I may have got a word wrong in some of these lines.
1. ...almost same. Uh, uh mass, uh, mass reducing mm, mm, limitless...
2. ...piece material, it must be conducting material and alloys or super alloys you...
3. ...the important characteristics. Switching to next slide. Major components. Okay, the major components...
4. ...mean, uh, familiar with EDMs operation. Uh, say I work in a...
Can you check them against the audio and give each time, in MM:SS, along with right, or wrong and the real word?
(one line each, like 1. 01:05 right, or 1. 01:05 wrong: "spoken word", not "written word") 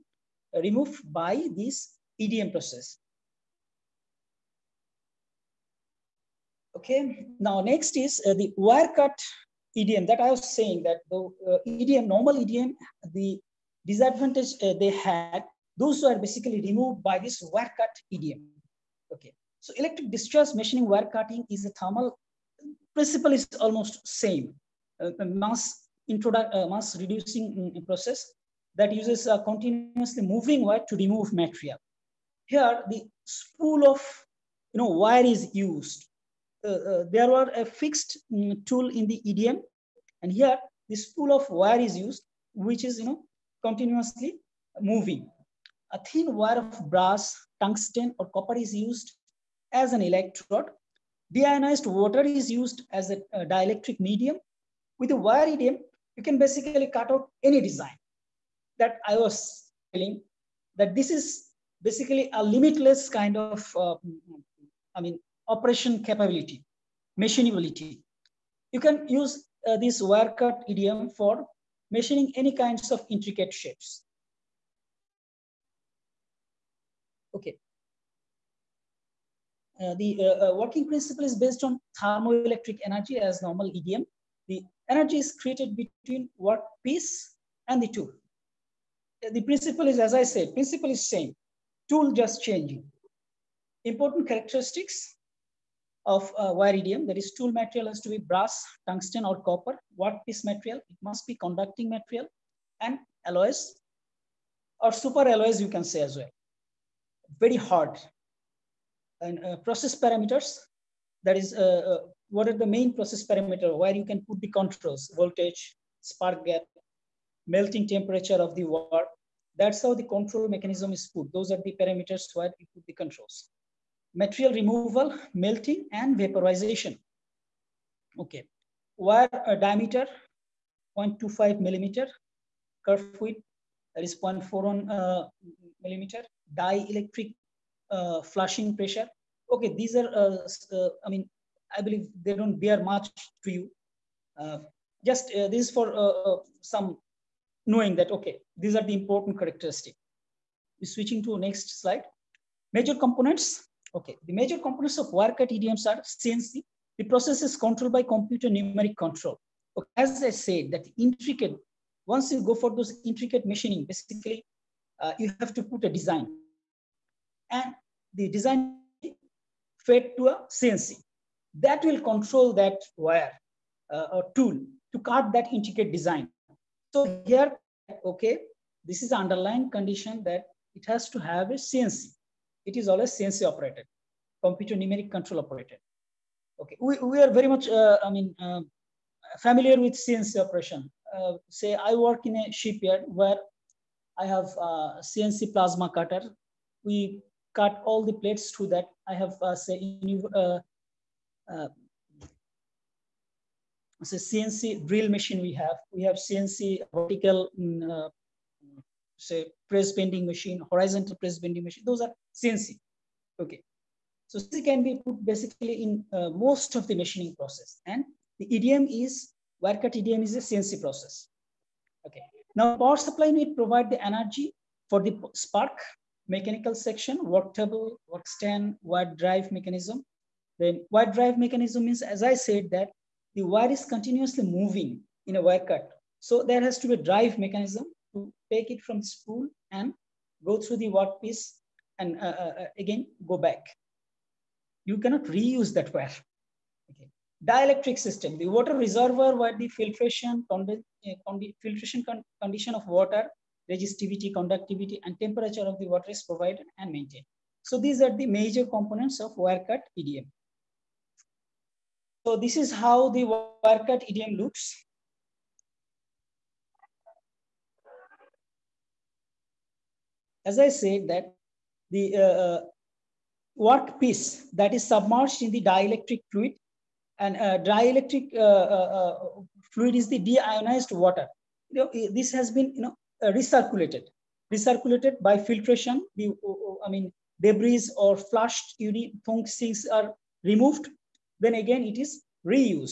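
1. 00:23 wrong: "process", not "limitless"
2. 01:40 right
3. 02:28 right
4. 03:08 wrong: "CNC", not "EDMs".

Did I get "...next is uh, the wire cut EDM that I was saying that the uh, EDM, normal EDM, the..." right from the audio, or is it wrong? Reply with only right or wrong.
right.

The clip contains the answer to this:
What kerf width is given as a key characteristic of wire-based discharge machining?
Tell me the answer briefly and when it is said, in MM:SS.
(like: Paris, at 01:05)
0.41 mm, at 02:14.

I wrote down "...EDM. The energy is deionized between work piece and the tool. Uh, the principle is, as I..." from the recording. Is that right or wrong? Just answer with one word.
wrong.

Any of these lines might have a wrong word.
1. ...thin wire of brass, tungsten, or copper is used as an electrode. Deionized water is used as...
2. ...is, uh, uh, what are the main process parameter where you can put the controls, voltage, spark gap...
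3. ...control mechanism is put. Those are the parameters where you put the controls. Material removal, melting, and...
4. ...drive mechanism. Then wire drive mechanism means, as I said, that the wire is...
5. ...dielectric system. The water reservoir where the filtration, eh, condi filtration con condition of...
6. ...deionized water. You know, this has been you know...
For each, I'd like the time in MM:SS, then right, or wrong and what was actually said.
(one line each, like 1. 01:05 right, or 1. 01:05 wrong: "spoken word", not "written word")
1. 00:46 right
2. 01:51 right
3. 02:00 right
4. 03:49 right
5. 04:07 right
6. 04:40 right.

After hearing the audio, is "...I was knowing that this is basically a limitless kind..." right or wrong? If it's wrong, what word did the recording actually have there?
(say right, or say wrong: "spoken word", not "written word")
wrong: "telling", not "knowing".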